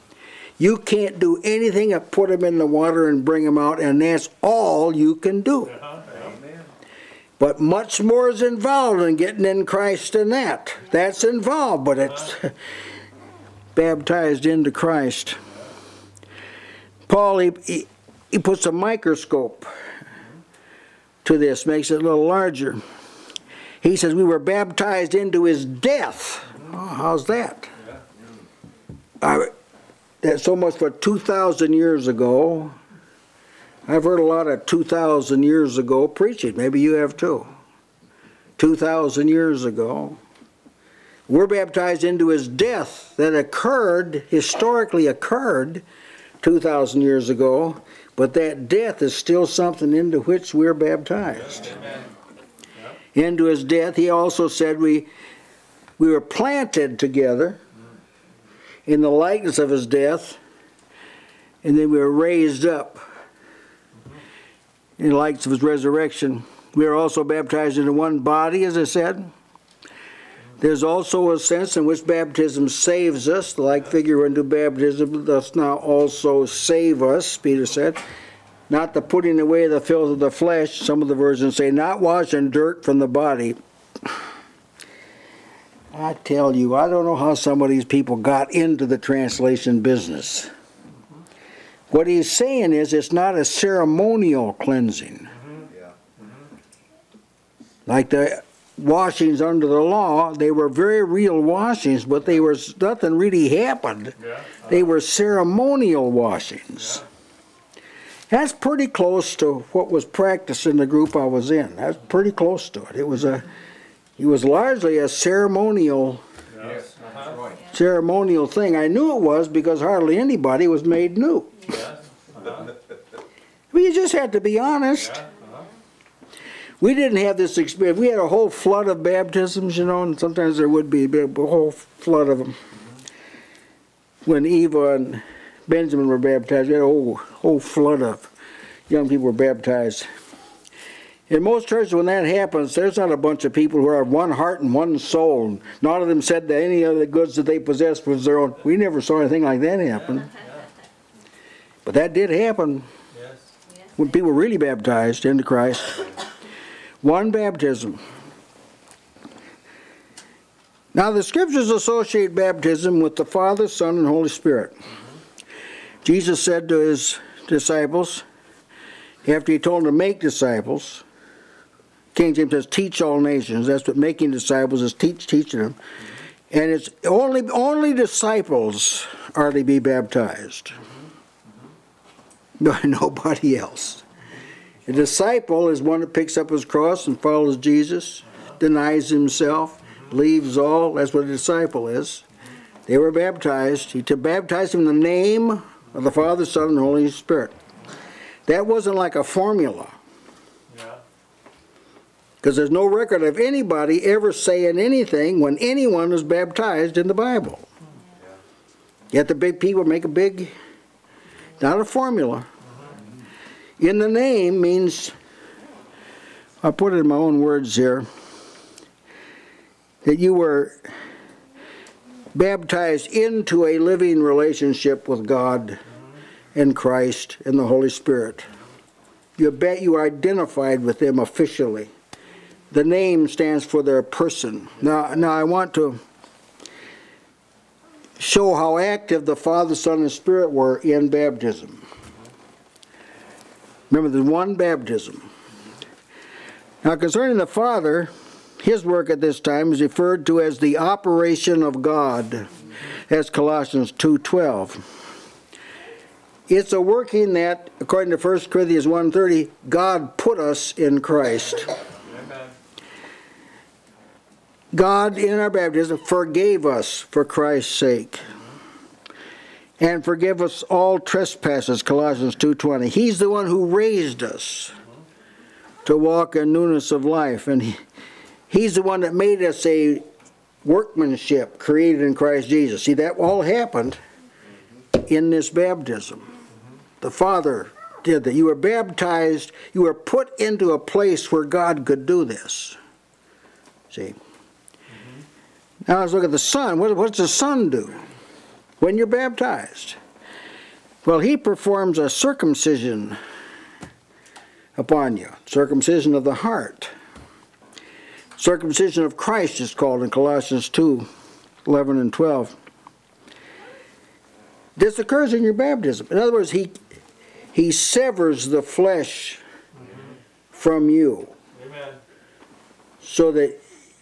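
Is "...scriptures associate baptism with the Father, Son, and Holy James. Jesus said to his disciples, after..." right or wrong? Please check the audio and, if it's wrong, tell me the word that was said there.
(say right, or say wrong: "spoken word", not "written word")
wrong: "Spirit", not "James".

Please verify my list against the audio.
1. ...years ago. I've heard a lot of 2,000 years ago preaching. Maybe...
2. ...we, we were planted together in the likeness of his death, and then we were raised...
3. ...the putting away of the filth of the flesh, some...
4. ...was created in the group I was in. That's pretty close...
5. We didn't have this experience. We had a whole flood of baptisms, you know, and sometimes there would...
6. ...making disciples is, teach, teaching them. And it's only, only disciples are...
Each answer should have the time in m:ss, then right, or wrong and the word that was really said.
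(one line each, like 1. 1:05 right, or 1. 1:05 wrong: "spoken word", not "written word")
1. 0:31 right
2. 0:54 right
3. 1:18 right
4. 1:49 wrong: "practiced", not "created"
5. 2:06 right
6. 2:53 right.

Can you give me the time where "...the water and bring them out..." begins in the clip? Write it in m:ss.
0:02.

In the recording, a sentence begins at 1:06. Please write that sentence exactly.
We are also baptized into one body, as I said.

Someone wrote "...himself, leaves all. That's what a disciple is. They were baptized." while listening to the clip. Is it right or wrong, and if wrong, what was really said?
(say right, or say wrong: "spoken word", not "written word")
right.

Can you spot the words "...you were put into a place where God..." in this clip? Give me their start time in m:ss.
4:49.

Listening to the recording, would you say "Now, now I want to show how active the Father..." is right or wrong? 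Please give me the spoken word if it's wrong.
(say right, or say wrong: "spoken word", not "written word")
right.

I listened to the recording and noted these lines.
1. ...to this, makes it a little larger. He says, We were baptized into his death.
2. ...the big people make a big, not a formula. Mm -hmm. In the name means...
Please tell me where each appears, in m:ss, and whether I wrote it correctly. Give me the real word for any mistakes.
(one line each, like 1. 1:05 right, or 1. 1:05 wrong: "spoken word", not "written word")
1. 0:21 right
2. 3:29 right.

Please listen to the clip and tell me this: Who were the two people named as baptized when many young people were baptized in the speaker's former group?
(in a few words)
Eva and Benjamin.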